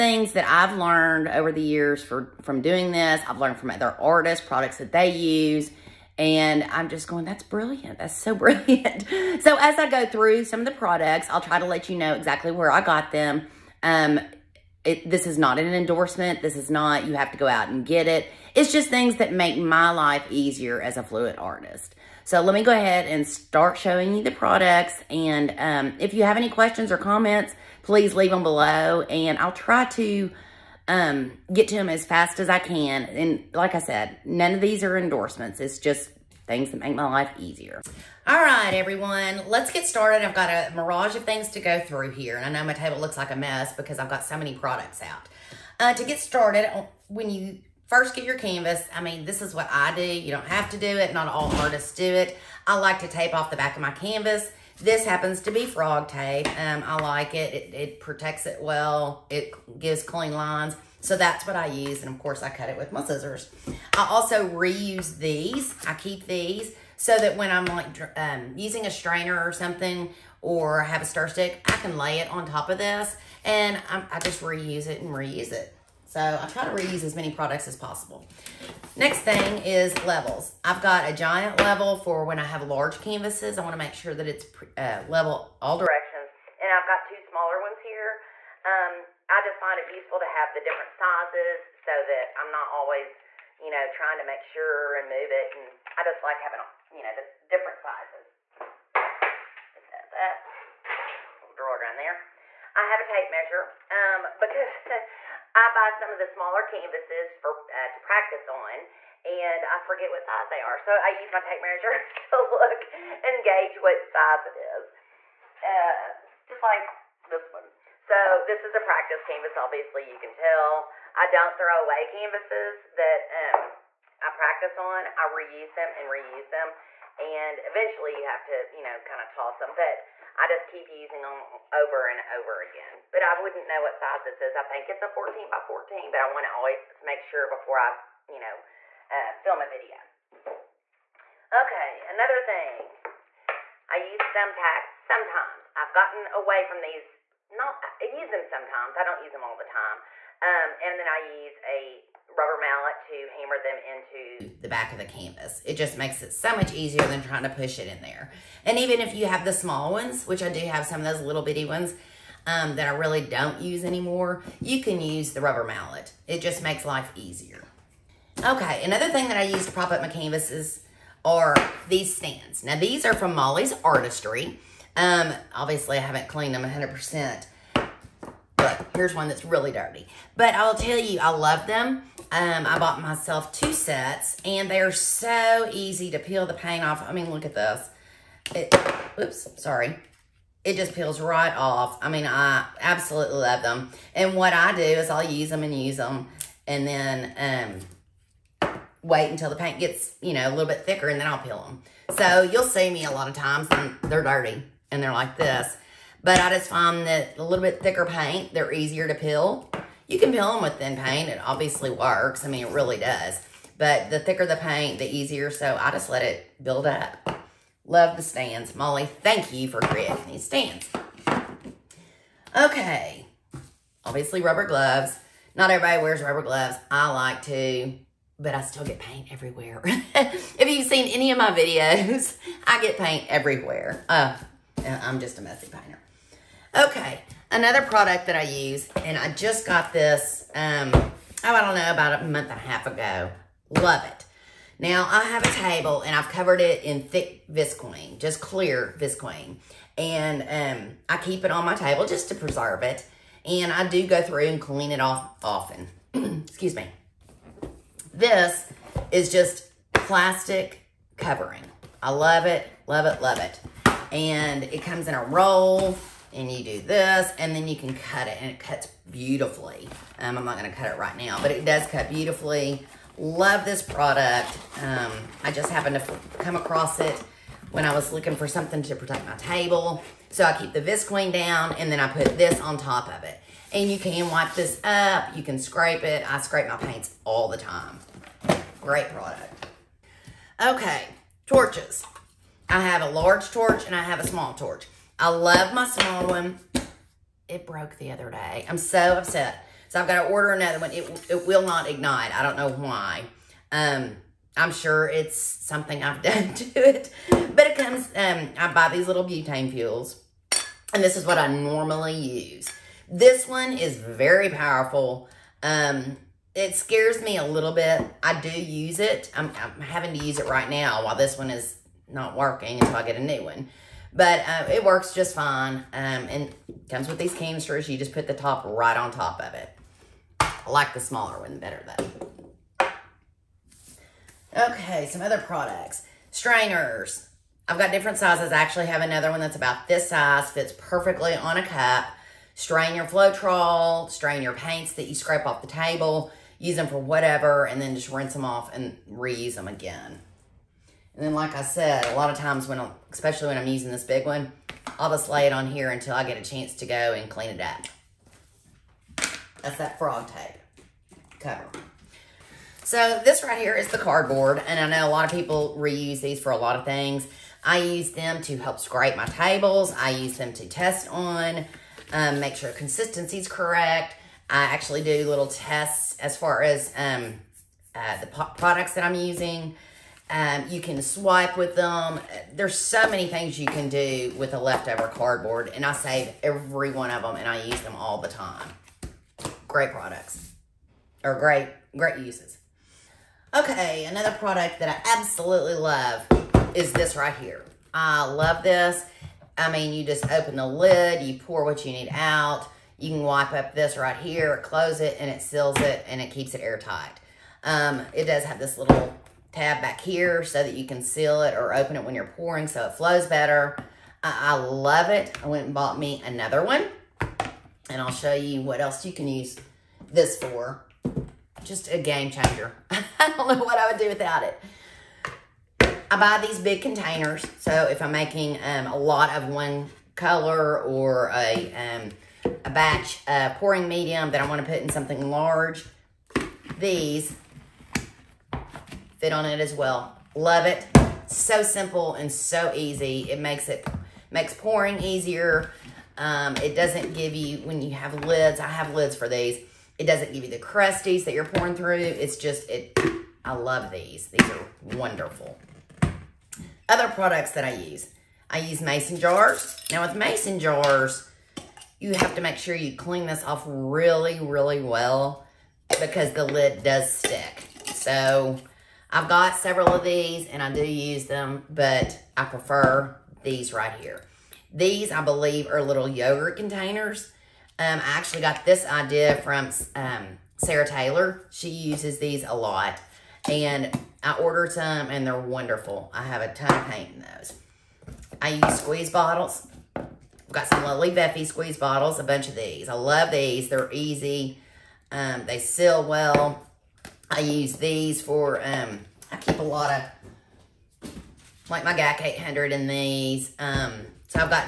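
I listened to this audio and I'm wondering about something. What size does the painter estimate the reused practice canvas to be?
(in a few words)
14 by 14.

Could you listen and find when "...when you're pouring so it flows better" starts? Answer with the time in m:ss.
6:52.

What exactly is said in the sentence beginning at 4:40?
So I keep the Visqueen down, and then I put this on top of it.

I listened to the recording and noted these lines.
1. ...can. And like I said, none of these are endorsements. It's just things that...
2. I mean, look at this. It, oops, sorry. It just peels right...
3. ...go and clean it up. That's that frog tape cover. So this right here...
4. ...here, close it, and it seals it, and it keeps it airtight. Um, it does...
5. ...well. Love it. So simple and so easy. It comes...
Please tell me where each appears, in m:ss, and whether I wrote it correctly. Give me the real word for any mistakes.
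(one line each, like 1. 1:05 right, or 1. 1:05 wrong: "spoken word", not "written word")
1. 0:32 right
2. 3:07 right
3. 5:56 right
4. 6:44 right
5. 7:19 wrong: "makes", not "comes".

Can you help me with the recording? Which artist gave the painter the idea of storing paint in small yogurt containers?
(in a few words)
Sarah Taylor.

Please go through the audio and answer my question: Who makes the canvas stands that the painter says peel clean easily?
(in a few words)
Molly's Artistry.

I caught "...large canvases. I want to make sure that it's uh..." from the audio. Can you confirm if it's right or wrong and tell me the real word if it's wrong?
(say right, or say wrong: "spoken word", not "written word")
right.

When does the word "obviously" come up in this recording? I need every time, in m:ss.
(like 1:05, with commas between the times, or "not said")
1:59, 2:55, 3:31, 3:44.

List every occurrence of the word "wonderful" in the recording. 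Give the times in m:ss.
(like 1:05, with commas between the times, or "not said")
7:34, 8:05.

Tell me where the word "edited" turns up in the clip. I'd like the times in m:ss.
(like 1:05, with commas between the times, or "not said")
not said.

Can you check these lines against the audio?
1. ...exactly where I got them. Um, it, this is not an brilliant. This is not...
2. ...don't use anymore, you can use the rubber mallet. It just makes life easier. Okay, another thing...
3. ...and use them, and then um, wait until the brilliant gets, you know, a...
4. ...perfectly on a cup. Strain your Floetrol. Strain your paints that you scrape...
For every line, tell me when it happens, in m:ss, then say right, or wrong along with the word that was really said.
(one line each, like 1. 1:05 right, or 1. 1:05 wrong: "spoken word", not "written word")
1. 0:12 wrong: "endorsement", not "brilliant"
2. 2:43 right
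3. 3:15 wrong: "paint", not "brilliant"
4. 5:40 right.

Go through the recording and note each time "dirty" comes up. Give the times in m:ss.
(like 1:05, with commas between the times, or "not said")
2:59, 3:24.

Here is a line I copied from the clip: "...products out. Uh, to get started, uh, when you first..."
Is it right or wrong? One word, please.
right.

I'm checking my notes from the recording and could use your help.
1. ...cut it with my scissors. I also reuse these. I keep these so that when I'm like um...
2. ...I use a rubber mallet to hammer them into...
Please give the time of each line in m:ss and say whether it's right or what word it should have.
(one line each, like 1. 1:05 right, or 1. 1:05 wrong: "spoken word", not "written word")
1. 1:02 right
2. 2:31 right.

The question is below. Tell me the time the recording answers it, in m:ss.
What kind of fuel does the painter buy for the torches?
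5:09.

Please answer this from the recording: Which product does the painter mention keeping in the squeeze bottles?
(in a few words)
GAC 800.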